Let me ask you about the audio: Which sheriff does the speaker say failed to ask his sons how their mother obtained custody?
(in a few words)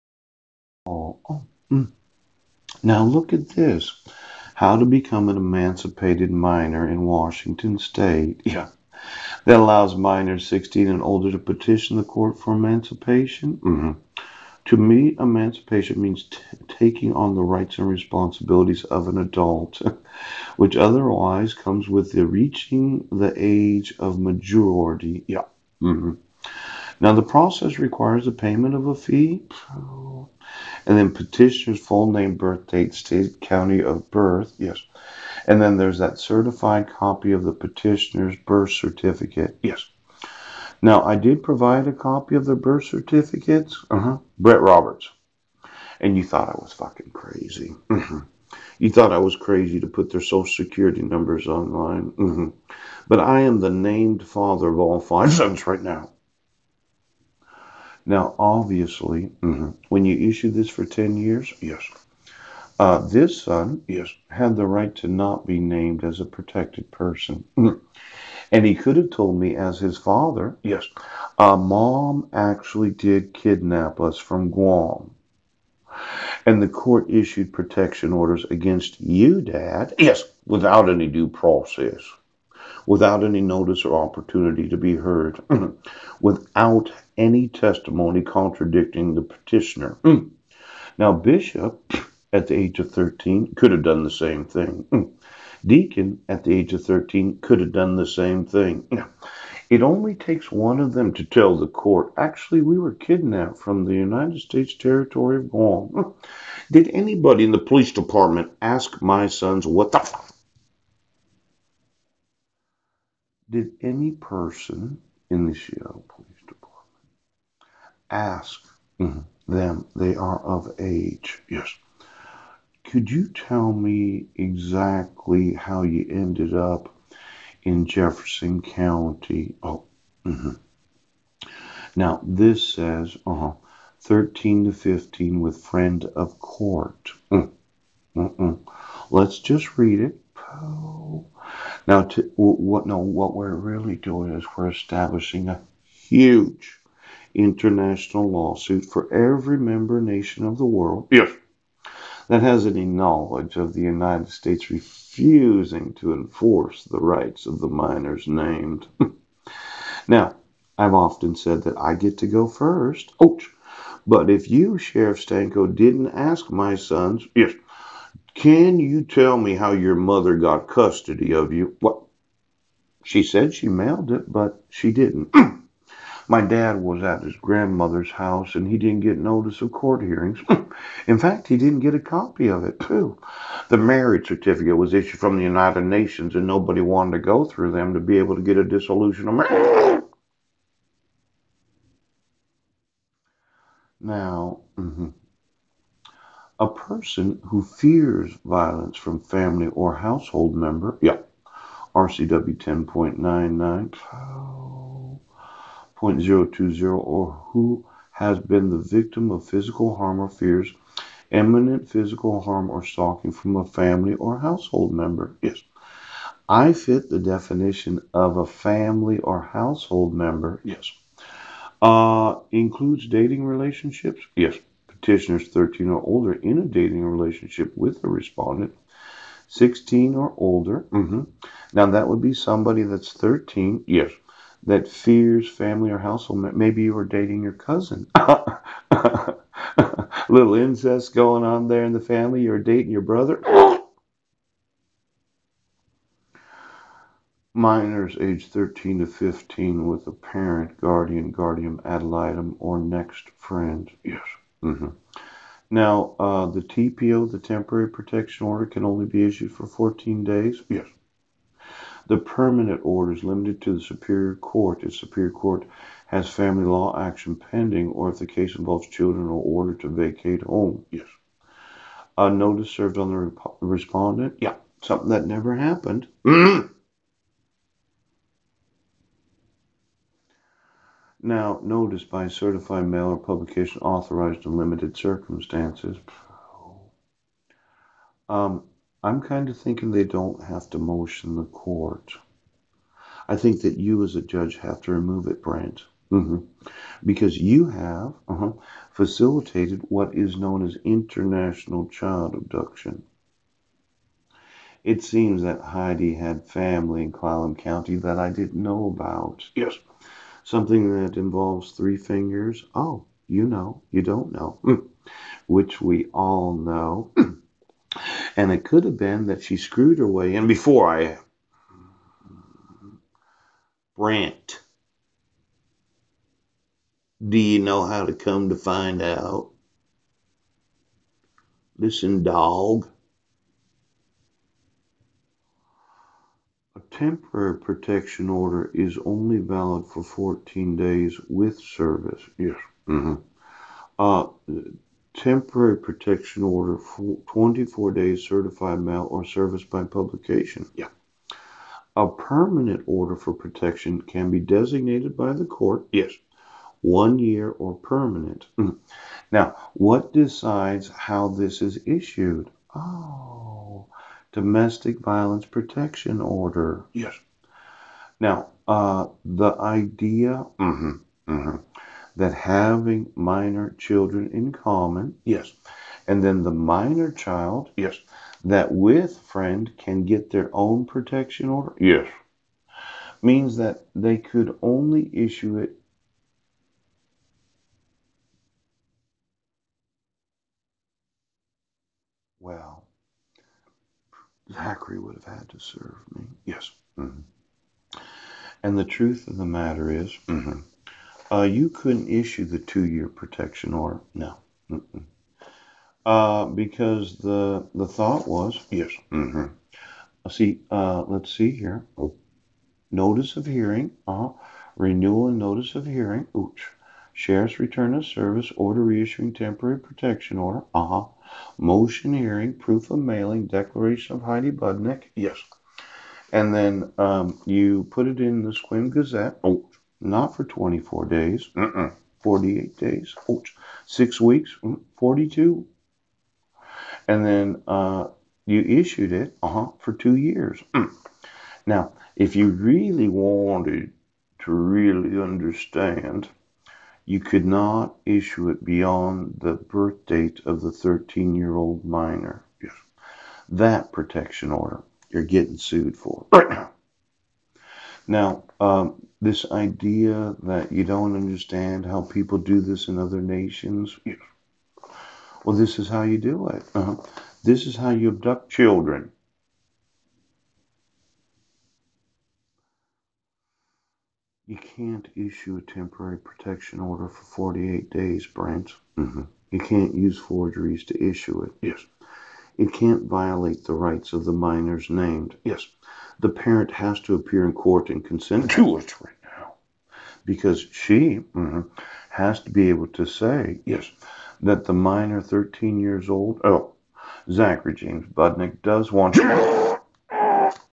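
Sheriff Stanko.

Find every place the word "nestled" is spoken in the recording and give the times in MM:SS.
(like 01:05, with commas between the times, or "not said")
not said.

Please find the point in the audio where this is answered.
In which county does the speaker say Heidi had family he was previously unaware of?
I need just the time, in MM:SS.
05:07.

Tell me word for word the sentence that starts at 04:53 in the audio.
I think that you as a judge have to remove it, Brent.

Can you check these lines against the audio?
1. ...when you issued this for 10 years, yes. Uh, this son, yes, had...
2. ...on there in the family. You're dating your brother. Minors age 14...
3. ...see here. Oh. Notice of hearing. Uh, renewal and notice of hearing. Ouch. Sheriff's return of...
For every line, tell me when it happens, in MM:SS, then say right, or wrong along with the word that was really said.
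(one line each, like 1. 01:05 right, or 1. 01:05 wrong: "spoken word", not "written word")
1. 00:59 right
2. 04:01 wrong: "13", not "14"
3. 06:51 right.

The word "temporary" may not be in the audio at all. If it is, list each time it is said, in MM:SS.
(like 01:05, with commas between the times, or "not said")
04:17, 05:36, 05:45, 06:59, 07:55.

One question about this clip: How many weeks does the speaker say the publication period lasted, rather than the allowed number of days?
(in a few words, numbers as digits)
6.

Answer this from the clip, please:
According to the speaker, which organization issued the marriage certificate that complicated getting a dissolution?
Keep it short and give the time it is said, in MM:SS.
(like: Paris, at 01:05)
United Nations, at 03:05.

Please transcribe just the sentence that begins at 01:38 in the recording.
Now, it only takes one of them to tell the court, actually, we were kidnapped from the United States territory of Guam.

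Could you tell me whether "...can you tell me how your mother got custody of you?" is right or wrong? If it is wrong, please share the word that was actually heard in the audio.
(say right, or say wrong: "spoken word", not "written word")
right.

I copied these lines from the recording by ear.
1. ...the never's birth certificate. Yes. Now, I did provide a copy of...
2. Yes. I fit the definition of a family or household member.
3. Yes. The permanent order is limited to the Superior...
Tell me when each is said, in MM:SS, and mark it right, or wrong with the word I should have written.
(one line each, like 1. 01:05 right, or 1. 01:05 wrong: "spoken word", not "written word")
1. 00:37 wrong: "petitioner", not "never"
2. 03:35 right
3. 04:20 right.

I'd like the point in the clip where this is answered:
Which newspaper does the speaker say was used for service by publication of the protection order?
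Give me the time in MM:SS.
07:08.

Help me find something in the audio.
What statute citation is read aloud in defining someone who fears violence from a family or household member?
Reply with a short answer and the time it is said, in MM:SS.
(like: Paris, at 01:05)
RCW 10.99.020, at 03:21.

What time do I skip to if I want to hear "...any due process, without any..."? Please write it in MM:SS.
01:20.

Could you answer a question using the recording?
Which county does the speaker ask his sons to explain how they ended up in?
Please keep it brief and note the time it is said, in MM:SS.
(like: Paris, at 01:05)
Jefferson County, at 02:07.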